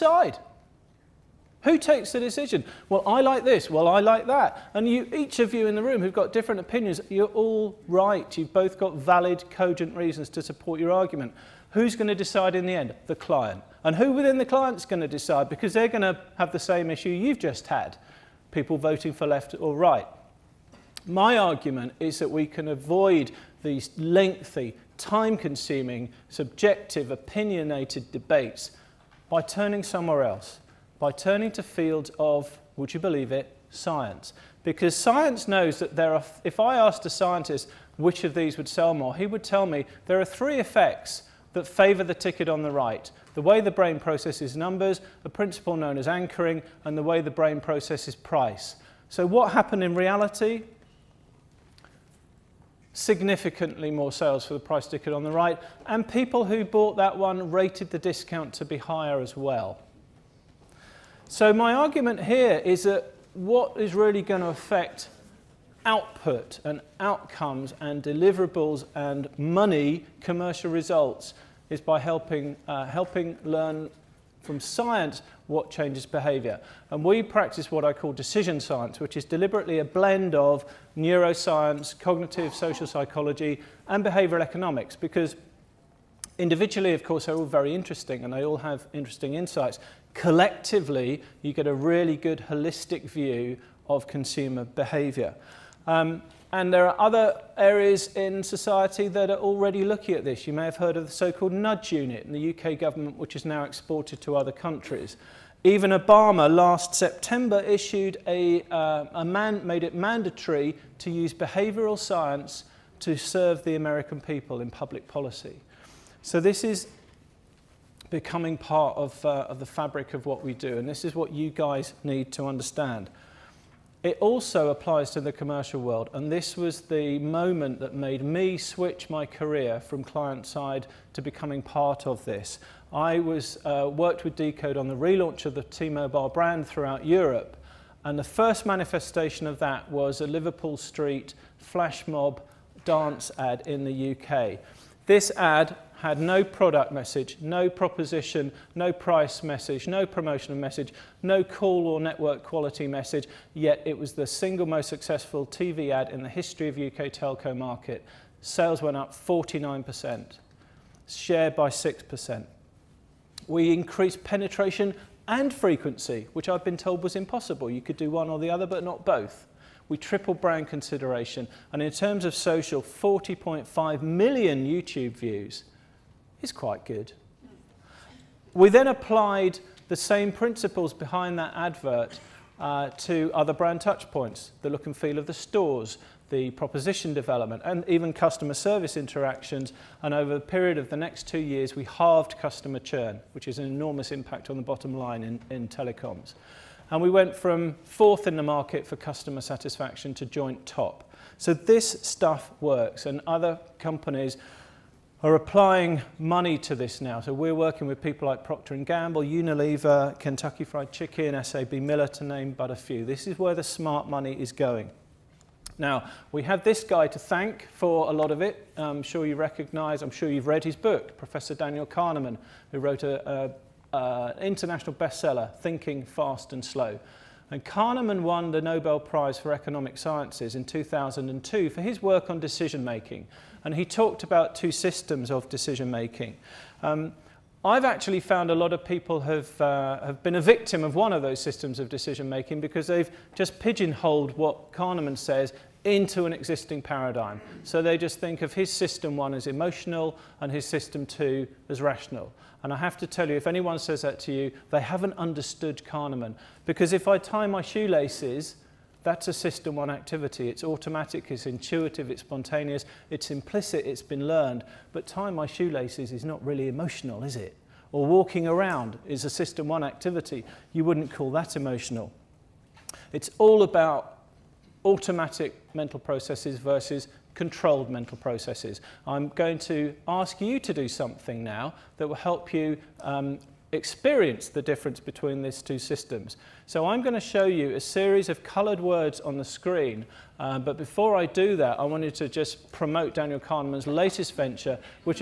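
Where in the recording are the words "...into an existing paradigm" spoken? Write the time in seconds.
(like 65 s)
245 s.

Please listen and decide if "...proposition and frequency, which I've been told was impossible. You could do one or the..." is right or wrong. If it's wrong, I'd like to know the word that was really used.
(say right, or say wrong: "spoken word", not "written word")
wrong: "penetration", not "proposition".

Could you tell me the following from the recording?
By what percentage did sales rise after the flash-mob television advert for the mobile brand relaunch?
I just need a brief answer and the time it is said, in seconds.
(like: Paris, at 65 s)
49%, at 159 s.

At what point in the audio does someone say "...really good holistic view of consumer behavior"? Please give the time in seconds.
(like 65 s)
91 s.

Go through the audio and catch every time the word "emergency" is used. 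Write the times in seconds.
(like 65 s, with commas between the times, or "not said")
not said.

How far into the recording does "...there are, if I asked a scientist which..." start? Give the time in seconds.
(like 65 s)
35 s.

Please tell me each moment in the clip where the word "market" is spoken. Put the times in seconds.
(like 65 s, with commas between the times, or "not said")
157 s, 198 s.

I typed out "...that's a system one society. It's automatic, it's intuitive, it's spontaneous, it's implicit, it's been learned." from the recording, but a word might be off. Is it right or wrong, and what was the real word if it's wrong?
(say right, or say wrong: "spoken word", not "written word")
wrong: "activity", not "society".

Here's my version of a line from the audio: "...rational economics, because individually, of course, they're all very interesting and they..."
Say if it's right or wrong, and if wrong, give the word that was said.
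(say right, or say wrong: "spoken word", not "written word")
wrong: "behavioral", not "rational".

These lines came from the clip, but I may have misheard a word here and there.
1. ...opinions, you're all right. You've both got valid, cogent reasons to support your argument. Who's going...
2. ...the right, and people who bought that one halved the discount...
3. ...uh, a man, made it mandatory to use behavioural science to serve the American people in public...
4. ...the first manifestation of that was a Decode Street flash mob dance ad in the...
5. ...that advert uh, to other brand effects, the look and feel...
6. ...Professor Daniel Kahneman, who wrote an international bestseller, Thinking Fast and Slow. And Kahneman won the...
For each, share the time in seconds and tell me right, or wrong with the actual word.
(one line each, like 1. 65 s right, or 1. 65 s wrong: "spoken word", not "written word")
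1. 6 s right
2. 55 s wrong: "rated", not "halved"
3. 108 s right
4. 138 s wrong: "Liverpool", not "Decode"
5. 181 s wrong: "touchpoints", not "effects"
6. 221 s right.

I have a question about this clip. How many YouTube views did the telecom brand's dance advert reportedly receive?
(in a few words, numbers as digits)
40.5 million.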